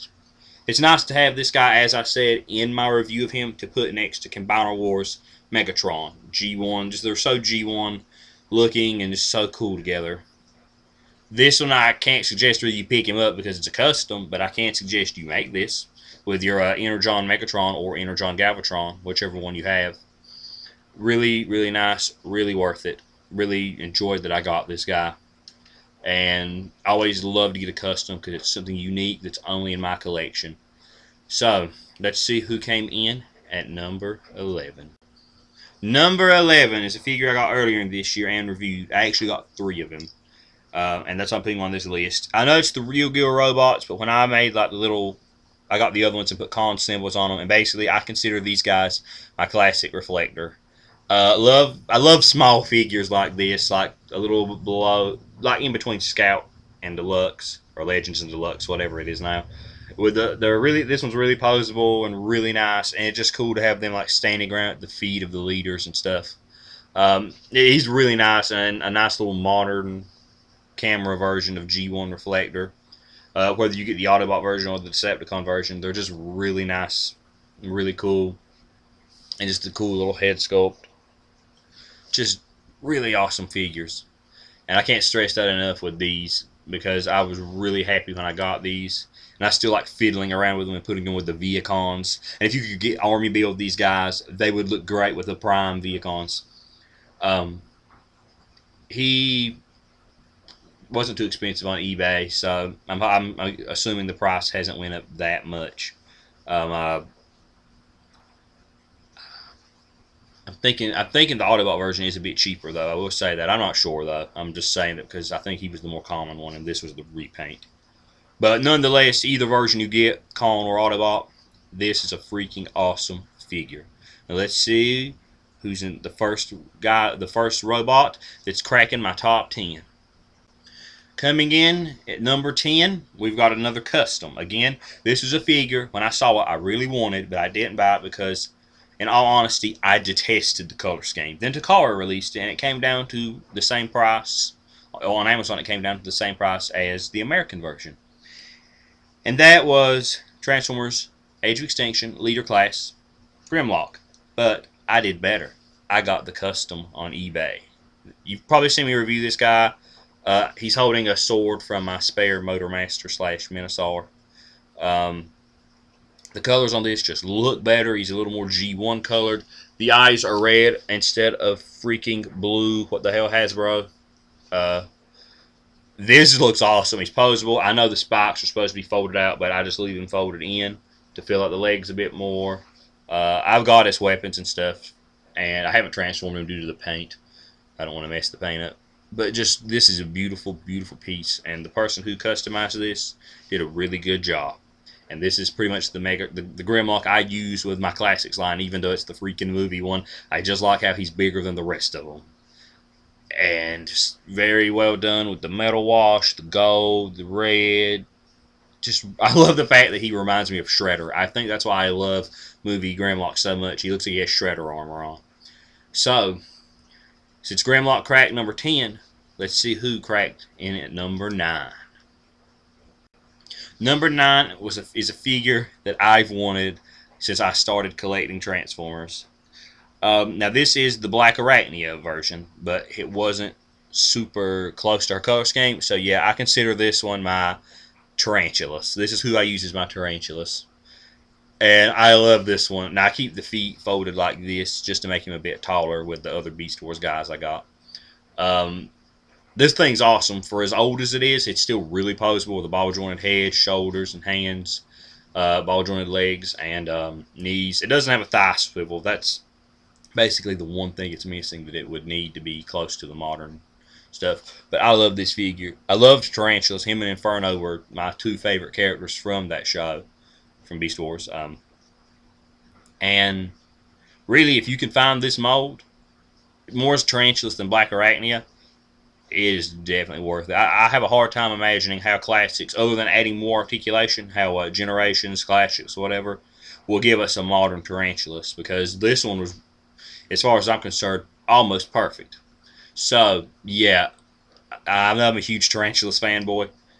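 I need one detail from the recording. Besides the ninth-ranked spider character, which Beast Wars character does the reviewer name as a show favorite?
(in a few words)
Inferno.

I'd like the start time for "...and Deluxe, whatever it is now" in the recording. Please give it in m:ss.
0:58.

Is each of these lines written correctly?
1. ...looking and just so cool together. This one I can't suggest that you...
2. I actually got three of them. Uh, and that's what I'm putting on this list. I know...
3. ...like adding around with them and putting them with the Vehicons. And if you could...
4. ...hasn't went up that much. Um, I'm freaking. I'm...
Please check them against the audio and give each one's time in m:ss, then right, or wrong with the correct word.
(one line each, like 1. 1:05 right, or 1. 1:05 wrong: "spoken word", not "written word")
1. 0:08 right
2. 0:38 right
3. 1:29 wrong: "fiddling", not "adding"
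4. 1:44 wrong: "thinking", not "freaking".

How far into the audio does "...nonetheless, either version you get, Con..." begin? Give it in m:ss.
1:58.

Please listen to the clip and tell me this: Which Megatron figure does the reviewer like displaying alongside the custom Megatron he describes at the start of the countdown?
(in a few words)
Combiner Wars Megatron.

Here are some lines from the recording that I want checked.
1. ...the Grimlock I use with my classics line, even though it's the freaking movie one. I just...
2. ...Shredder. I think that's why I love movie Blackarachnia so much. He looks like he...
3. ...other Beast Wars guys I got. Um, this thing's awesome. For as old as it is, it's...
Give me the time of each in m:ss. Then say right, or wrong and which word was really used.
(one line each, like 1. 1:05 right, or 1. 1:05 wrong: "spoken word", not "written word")
1. 3:16 right
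2. 3:30 wrong: "Grimlock", not "Blackarachnia"
3. 4:06 right.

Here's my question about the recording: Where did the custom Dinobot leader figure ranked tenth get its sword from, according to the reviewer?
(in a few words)
Motormaster.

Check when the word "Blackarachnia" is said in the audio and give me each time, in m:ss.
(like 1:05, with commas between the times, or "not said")
3:51, 4:37.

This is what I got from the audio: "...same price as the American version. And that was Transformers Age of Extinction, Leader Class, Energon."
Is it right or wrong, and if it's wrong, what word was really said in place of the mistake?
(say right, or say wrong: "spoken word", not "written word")
wrong: "Grimlock", not "Energon".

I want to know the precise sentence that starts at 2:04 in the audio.
Now let's see who's in the first guy, the first robot that's cracking my top ten.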